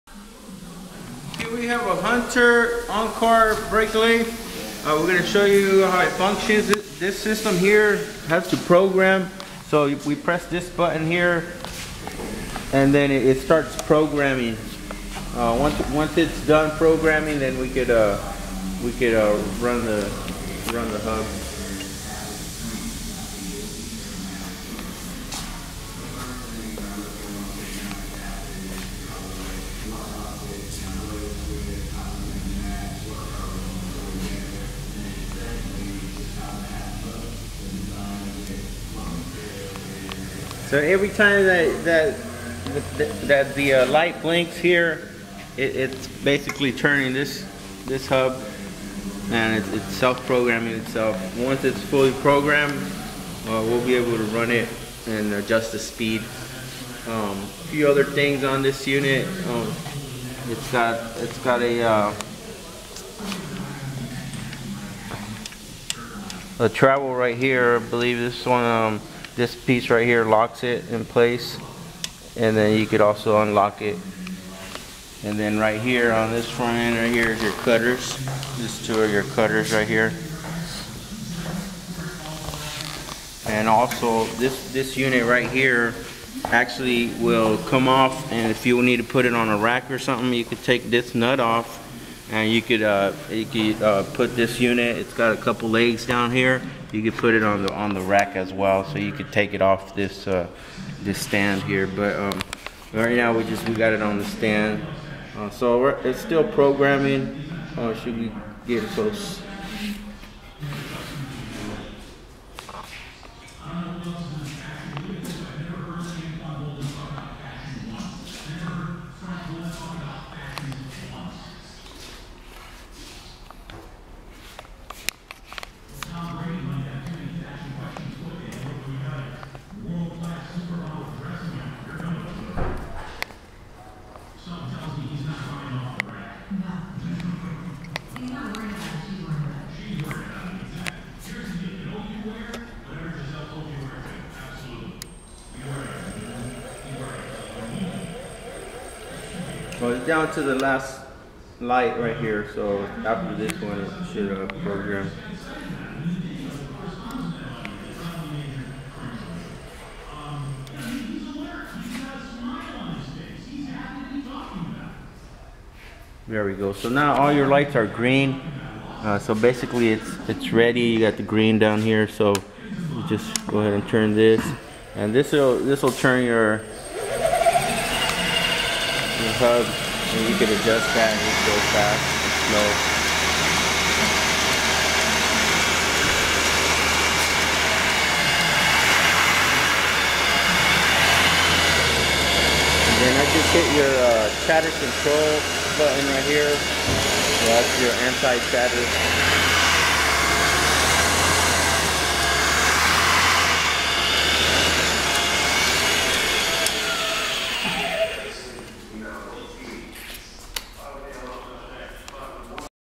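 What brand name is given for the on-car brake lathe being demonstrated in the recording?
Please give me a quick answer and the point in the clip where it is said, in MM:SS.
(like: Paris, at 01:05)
Hunter, at 00:02.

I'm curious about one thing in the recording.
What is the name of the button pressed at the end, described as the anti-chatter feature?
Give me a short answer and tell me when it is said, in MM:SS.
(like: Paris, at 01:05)
chatter control, at 03:14.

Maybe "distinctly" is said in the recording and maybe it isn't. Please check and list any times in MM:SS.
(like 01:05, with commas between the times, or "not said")
not said.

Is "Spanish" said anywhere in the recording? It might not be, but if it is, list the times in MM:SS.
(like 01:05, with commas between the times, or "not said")
not said.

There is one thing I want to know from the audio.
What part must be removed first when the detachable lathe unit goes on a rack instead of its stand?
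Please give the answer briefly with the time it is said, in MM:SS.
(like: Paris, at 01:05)
nut, at 01:31.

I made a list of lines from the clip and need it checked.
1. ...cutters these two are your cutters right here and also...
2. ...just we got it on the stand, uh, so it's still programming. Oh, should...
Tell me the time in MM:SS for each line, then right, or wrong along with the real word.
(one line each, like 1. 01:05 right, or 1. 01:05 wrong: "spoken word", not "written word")
1. 01:17 right
2. 01:43 right.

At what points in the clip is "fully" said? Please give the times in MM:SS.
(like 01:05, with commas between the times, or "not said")
00:51.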